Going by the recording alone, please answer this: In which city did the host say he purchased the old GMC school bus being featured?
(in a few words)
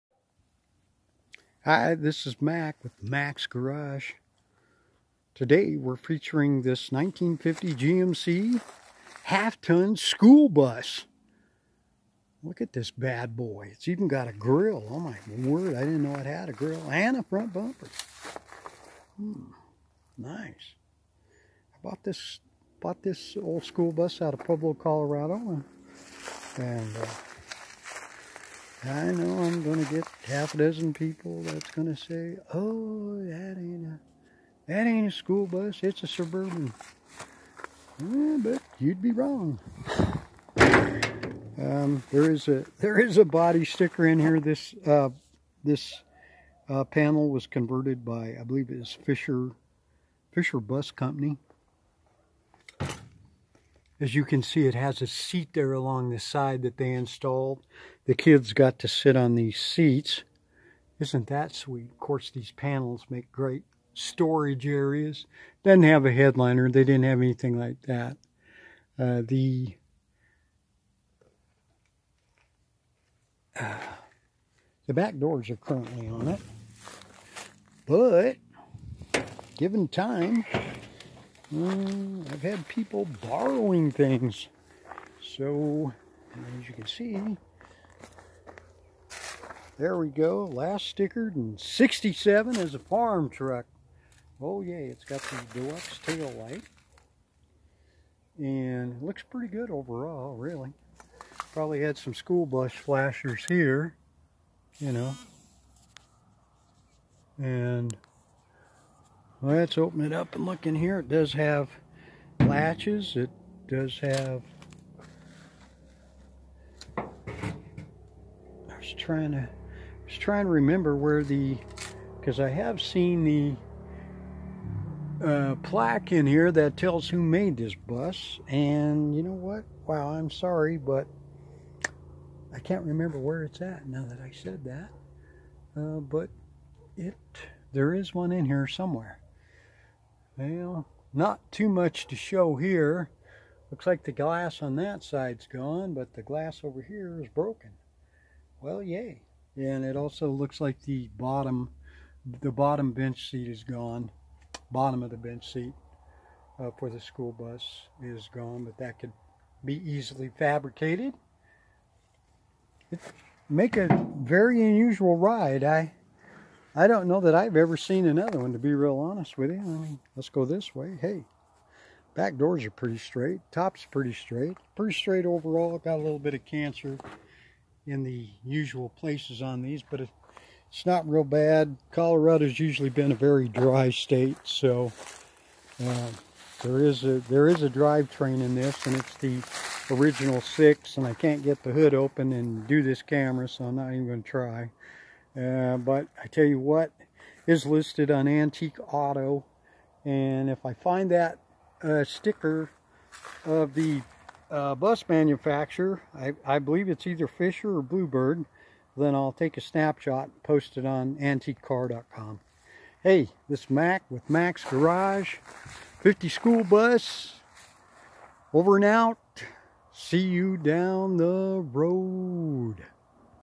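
Pueblo, Colorado.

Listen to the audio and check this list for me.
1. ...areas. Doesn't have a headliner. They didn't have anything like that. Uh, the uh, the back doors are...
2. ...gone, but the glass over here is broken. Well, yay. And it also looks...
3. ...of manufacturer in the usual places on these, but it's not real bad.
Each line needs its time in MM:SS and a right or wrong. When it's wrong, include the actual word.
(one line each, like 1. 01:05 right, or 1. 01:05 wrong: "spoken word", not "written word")
1. 01:04 right
2. 02:25 right
3. 02:56 wrong: "cancer", not "manufacturer".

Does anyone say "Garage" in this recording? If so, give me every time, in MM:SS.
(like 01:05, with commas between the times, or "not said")
00:03, 03:34.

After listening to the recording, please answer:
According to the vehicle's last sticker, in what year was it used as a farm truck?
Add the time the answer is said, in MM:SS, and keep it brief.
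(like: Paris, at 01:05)
67, at 01:31.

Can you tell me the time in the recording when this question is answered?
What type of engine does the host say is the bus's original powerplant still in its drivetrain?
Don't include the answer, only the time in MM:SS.
03:10.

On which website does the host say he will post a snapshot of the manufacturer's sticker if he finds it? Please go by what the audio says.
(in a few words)
antiquecar.com.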